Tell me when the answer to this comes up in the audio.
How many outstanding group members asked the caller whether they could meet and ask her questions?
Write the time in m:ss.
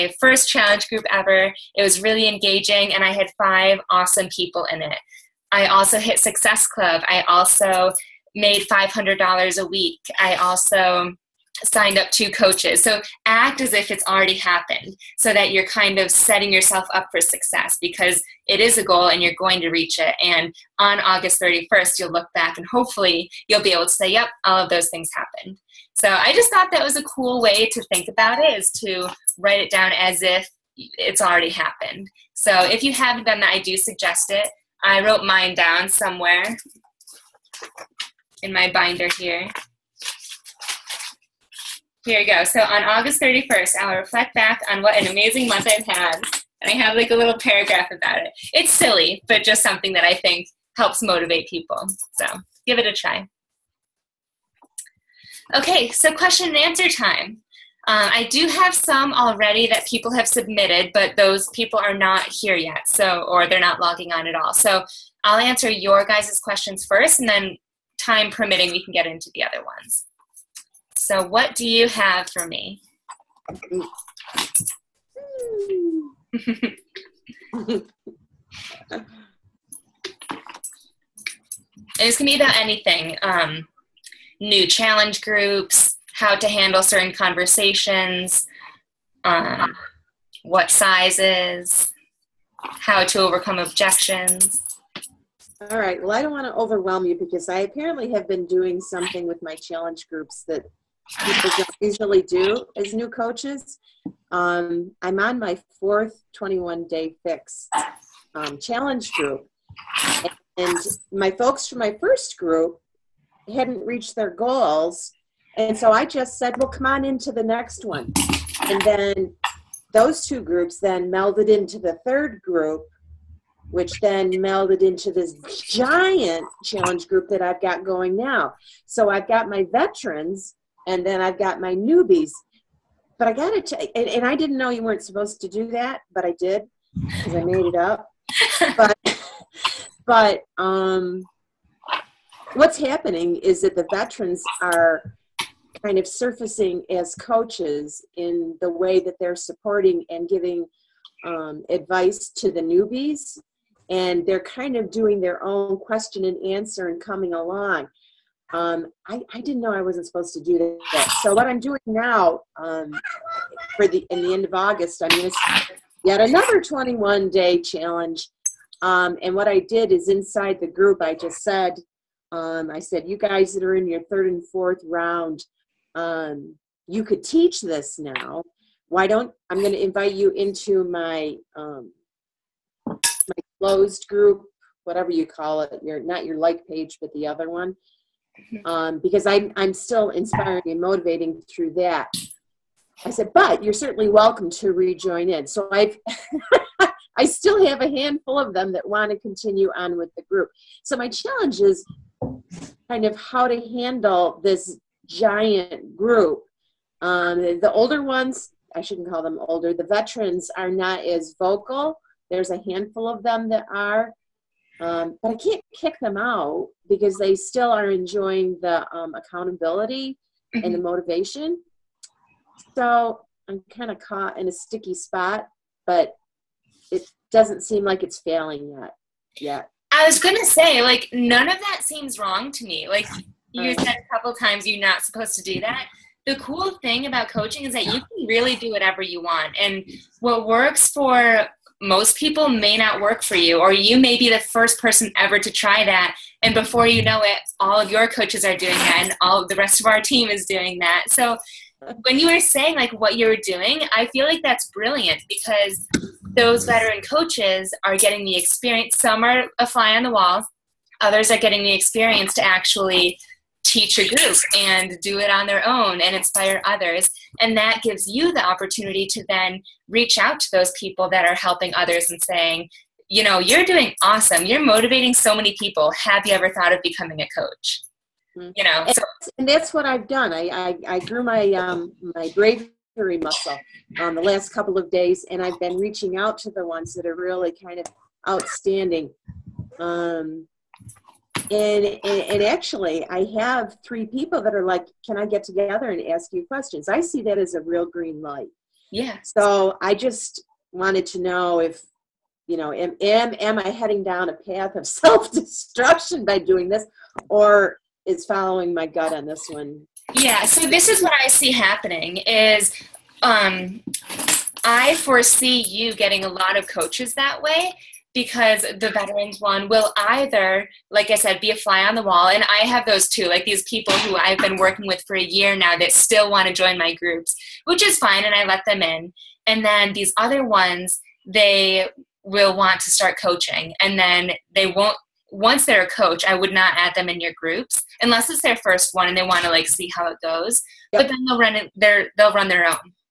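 4:53.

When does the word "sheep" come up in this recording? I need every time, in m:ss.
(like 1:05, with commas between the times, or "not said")
not said.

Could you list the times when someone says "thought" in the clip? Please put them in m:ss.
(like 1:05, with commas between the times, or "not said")
0:26, 4:36.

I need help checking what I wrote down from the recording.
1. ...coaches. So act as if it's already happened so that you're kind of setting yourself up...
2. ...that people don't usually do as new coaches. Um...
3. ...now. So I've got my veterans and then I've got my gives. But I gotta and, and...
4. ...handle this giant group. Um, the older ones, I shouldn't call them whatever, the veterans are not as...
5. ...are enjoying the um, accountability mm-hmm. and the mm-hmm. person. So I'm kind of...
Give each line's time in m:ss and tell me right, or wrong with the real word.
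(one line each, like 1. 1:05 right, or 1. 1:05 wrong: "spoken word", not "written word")
1. 0:12 right
2. 1:40 right
3. 2:08 wrong: "newbies", not "gives"
4. 3:23 wrong: "older", not "whatever"
5. 3:37 wrong: "motivation", not "person".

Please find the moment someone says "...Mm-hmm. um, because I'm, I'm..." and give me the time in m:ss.
3:08.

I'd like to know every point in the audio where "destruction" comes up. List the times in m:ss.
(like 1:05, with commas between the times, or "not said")
5:04.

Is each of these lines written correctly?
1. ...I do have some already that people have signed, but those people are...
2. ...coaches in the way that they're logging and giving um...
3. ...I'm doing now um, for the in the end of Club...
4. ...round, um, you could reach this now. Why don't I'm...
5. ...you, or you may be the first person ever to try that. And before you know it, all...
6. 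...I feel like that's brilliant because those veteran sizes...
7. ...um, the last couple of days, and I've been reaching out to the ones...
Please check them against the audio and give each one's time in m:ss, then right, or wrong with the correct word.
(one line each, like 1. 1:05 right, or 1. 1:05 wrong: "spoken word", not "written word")
1. 0:58 wrong: "submitted", not "signed"
2. 2:27 wrong: "supporting", not "logging"
3. 2:41 wrong: "August", not "Club"
4. 2:54 wrong: "teach", not "reach"
5. 4:03 right
6. 4:13 wrong: "coaches", not "sizes"
7. 4:44 right.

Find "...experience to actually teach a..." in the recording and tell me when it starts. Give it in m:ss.
4:21.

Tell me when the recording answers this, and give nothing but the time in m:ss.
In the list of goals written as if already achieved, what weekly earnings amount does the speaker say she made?
0:08.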